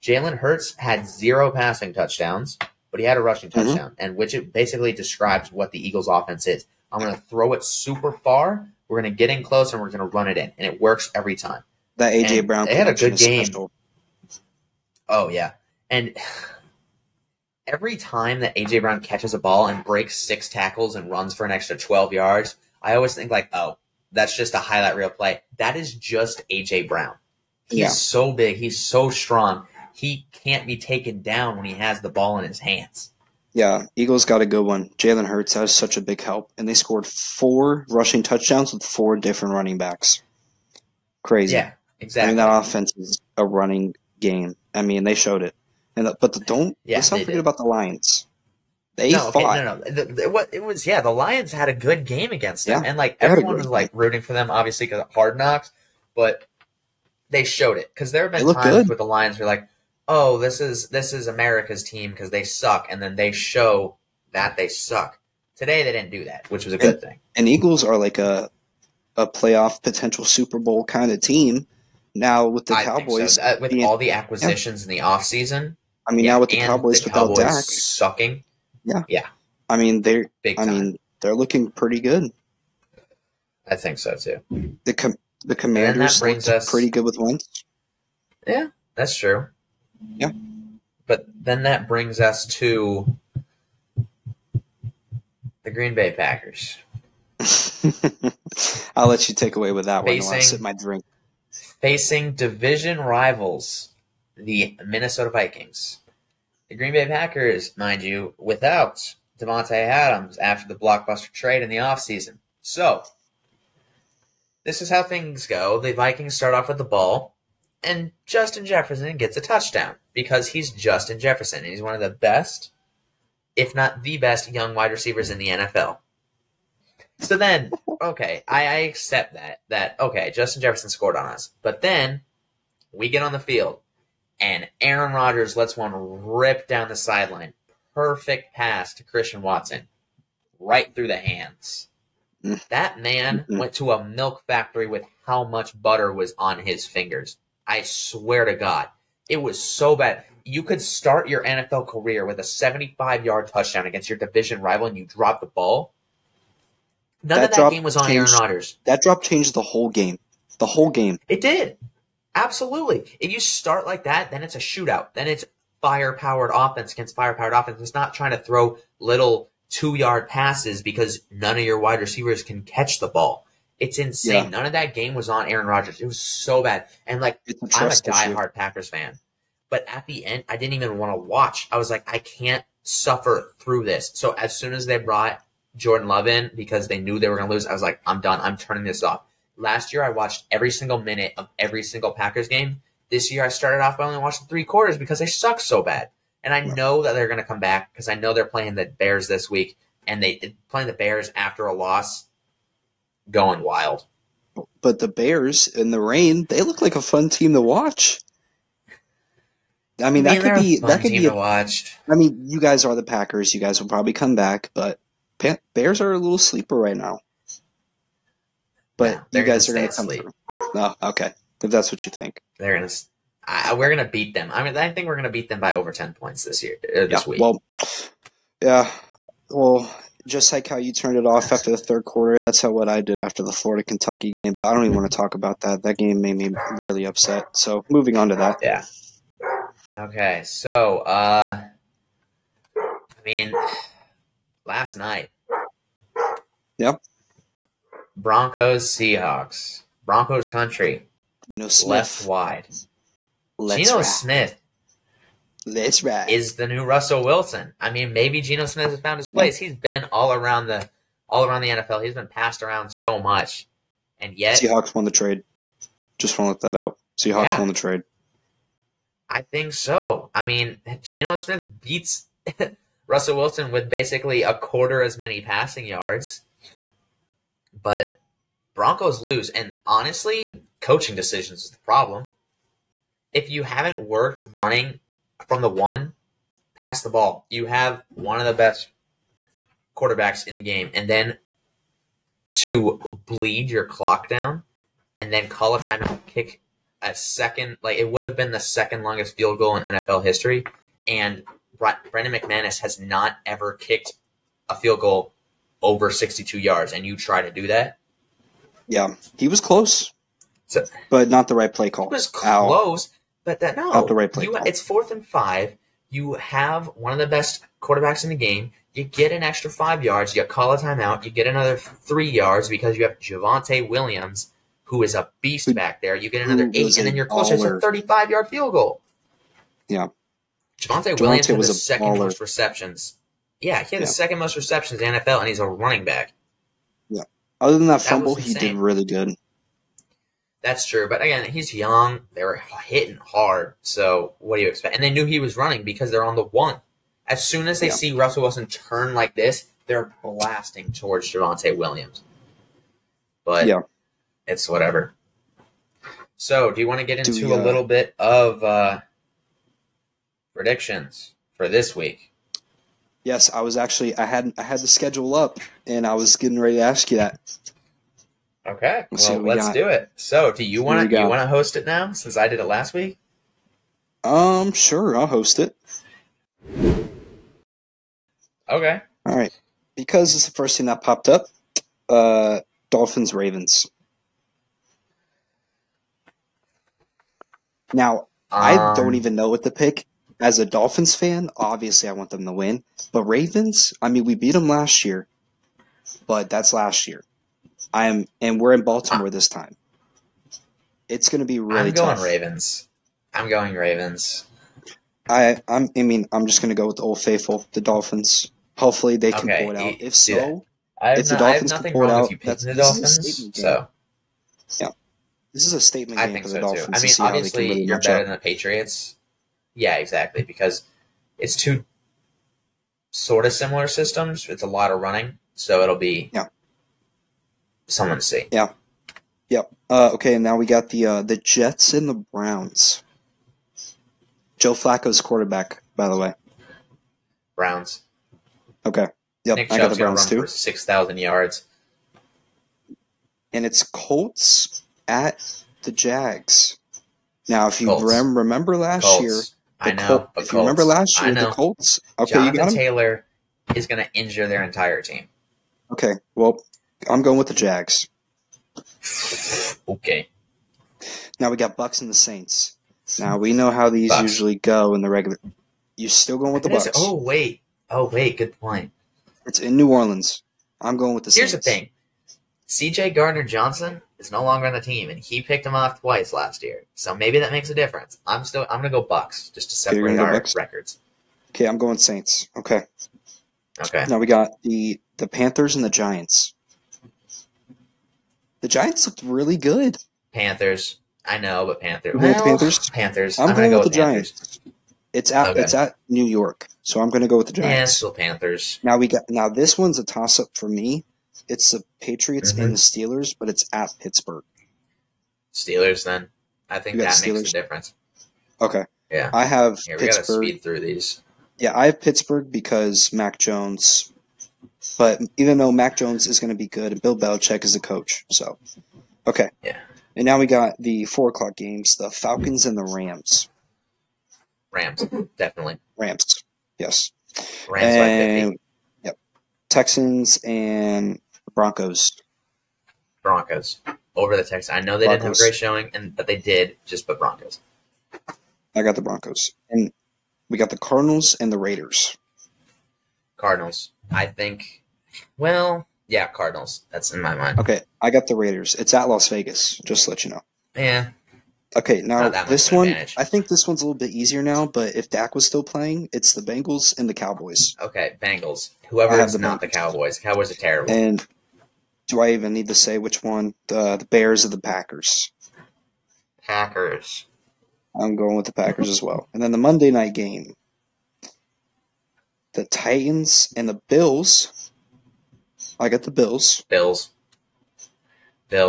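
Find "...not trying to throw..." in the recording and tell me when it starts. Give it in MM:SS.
02:47.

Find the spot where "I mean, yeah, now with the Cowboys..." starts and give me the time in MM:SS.
01:16.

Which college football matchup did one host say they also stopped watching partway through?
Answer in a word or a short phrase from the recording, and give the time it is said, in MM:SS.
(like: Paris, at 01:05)
Florida Kentucky, at 03:53.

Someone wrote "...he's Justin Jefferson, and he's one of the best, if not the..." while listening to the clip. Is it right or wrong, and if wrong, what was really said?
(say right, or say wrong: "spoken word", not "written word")
right.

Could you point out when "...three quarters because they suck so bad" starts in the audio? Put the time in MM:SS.
03:14.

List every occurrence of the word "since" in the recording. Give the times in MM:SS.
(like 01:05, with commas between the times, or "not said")
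06:12.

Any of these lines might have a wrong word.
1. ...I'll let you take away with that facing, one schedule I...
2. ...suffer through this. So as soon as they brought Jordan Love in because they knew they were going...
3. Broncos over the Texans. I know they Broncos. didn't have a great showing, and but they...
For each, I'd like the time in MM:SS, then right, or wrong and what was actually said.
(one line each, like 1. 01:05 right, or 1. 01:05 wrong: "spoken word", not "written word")
1. 01:38 wrong: "while", not "schedule"
2. 03:02 right
3. 08:53 right.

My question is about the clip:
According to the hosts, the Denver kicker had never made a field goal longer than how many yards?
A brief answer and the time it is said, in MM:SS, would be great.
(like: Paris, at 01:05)
62, at 05:06.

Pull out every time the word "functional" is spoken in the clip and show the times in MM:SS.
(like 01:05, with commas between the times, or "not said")
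not said.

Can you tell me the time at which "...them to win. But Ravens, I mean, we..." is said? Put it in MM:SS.
06:32.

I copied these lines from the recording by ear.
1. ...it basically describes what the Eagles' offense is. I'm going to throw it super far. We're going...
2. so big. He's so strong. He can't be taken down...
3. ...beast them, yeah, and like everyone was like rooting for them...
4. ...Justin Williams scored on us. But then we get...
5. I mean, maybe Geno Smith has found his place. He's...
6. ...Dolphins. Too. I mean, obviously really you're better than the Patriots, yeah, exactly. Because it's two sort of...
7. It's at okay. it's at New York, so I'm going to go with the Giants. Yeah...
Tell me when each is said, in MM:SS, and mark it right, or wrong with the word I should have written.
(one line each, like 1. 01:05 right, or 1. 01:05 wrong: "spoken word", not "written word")
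1. 00:04 right
2. 00:27 right
3. 00:52 wrong: "against", not "beast"
4. 02:10 wrong: "Jefferson", not "Williams"
5. 04:17 right
6. 06:56 right
7. 08:15 right.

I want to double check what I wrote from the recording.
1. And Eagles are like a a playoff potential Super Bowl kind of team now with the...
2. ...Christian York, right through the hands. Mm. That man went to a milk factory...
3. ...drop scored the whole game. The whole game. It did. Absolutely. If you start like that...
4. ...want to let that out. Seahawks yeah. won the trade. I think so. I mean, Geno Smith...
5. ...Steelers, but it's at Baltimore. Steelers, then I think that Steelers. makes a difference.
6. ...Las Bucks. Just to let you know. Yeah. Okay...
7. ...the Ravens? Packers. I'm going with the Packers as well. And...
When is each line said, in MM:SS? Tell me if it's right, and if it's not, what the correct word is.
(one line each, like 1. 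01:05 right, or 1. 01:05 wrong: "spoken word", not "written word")
1. 01:07 right
2. 02:19 wrong: "Watson", not "York"
3. 02:39 wrong: "changed", not "scored"
4. 04:26 right
5. 08:22 wrong: "Pittsburgh", not "Baltimore"
6. 09:09 wrong: "Vegas", not "Bucks"
7. 09:24 wrong: "Packers", not "Ravens".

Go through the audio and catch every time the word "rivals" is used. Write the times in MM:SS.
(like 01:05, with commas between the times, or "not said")
01:42, 02:34.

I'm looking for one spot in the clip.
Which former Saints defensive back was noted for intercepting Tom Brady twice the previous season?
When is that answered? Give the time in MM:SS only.
07:52.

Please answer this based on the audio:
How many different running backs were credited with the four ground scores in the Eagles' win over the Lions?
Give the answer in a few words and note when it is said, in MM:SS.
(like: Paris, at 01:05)
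4, at 00:38.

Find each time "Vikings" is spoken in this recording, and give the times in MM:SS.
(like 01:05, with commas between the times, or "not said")
01:45, 01:55.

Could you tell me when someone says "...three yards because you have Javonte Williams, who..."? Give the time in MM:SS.
05:21.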